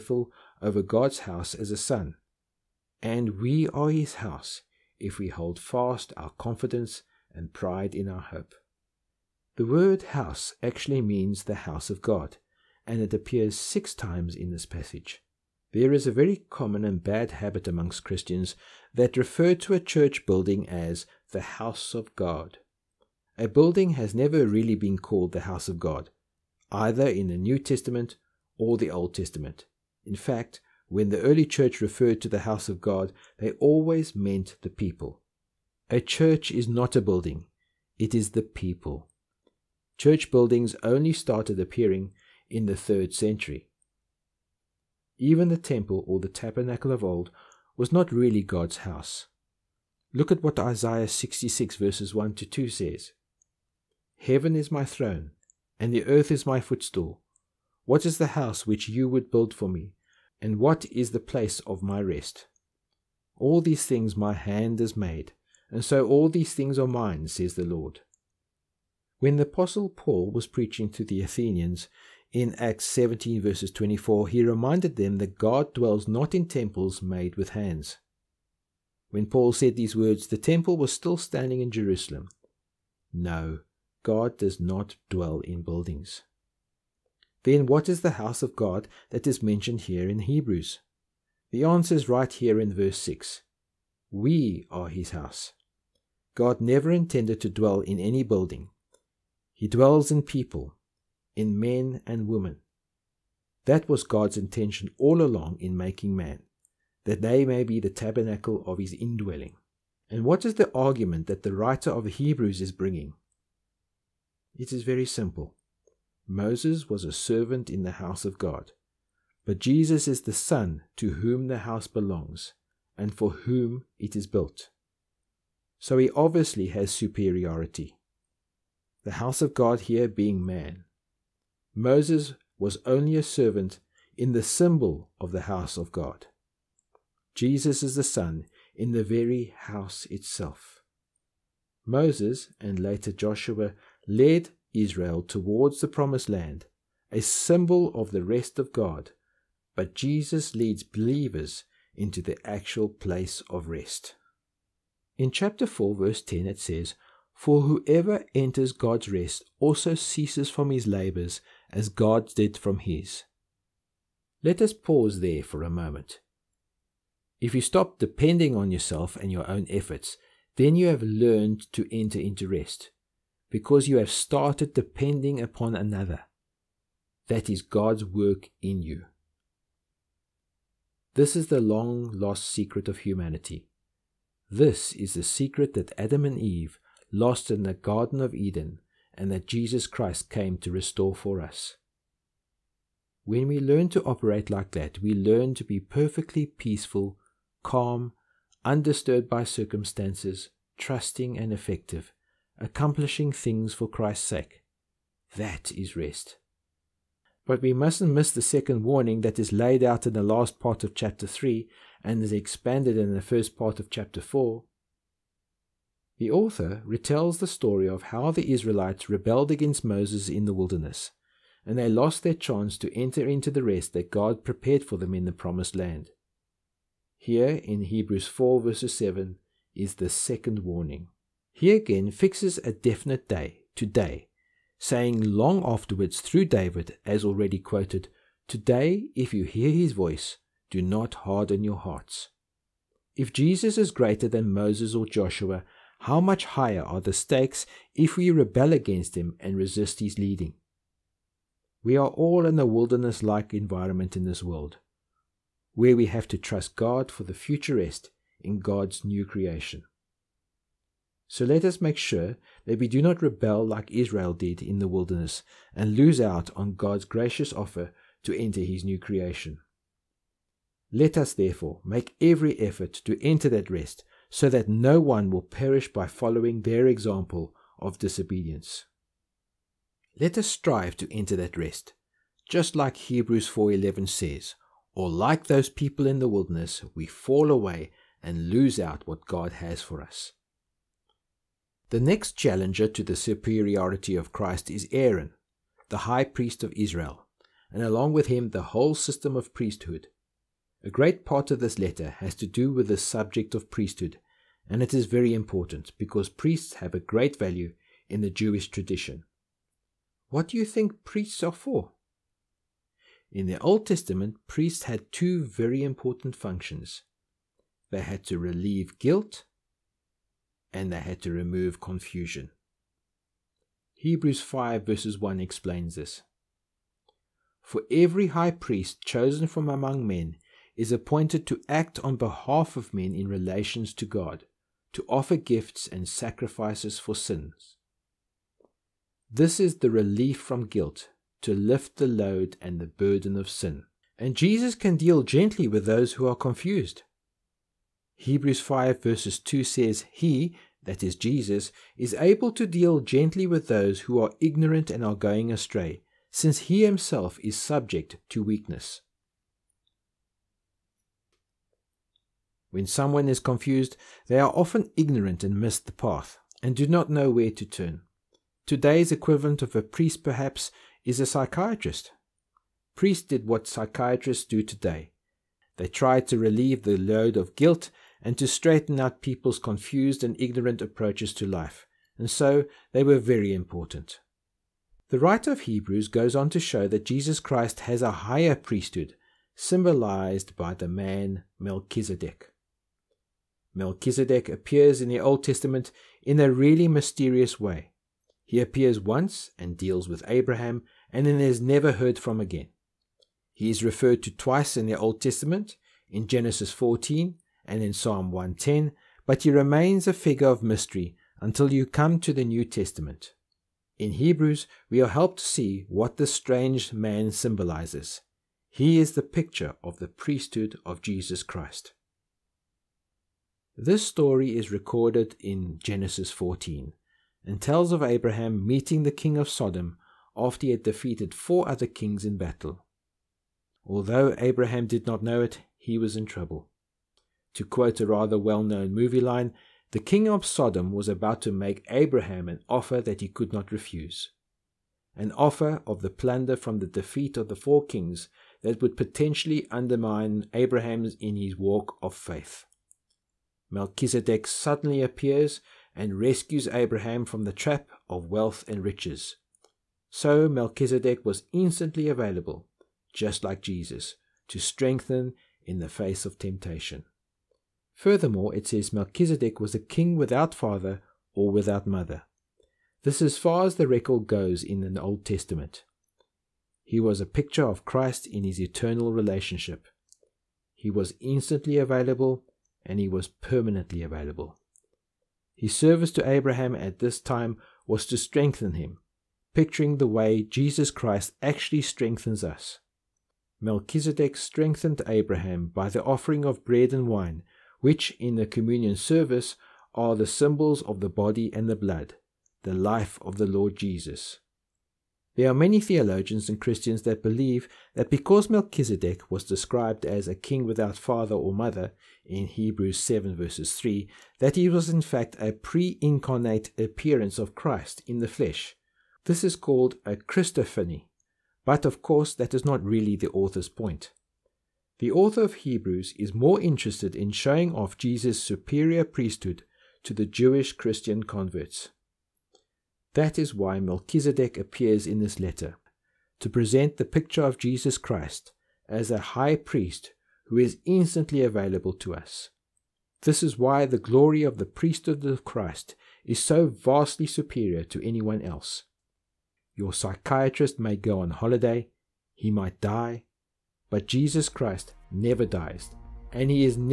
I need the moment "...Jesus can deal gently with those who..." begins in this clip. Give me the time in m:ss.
5:44.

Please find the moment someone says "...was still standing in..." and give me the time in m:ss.
1:20.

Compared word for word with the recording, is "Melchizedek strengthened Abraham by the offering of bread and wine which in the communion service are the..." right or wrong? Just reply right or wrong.
right.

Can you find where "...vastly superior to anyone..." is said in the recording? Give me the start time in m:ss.
9:06.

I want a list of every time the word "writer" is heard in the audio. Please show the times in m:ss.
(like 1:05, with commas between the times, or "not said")
1:51, 6:25.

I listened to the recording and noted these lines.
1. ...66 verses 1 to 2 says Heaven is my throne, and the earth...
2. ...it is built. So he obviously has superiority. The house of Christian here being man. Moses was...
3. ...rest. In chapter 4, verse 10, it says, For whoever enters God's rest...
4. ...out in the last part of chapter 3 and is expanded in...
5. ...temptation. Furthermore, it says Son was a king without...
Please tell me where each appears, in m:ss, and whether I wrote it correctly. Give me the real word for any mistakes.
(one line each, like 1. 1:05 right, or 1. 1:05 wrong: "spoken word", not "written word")
1. 0:51 right
2. 2:03 wrong: "God", not "Christian"
3. 2:33 right
4. 3:29 right
5. 7:46 wrong: "Melchizedek", not "Son".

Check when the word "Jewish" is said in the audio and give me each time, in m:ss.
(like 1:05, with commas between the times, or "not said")
5:08, 8:50.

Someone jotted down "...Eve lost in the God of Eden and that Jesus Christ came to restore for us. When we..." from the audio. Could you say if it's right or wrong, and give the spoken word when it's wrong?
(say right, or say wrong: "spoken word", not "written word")
wrong: "Garden", not "God".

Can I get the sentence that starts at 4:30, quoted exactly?
Let us therefore make every effort to enter that rest so that no one will perish by following their example of disobedience.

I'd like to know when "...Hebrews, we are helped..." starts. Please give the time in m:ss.
6:54.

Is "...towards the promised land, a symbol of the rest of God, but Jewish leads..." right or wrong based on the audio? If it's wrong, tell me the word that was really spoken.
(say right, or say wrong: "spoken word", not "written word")
wrong: "Jesus", not "Jewish".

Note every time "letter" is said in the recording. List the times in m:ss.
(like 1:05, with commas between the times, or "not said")
5:01, 8:55.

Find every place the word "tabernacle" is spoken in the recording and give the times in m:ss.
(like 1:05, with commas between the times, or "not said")
0:46, 1:47.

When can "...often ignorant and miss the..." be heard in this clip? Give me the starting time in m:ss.
6:04.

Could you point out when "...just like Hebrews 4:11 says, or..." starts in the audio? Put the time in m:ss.
4:42.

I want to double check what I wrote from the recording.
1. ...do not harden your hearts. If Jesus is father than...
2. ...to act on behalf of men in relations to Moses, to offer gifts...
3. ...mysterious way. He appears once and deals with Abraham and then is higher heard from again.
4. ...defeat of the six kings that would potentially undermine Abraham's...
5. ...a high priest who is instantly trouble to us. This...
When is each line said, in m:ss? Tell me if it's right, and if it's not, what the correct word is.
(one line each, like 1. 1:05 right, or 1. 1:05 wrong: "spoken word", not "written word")
1. 4:00 wrong: "greater", not "father"
2. 5:31 wrong: "God", not "Moses"
3. 6:36 wrong: "never", not "higher"
4. 7:26 wrong: "four", not "six"
5. 8:59 wrong: "available", not "trouble".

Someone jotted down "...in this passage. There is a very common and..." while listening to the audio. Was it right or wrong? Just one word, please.
right.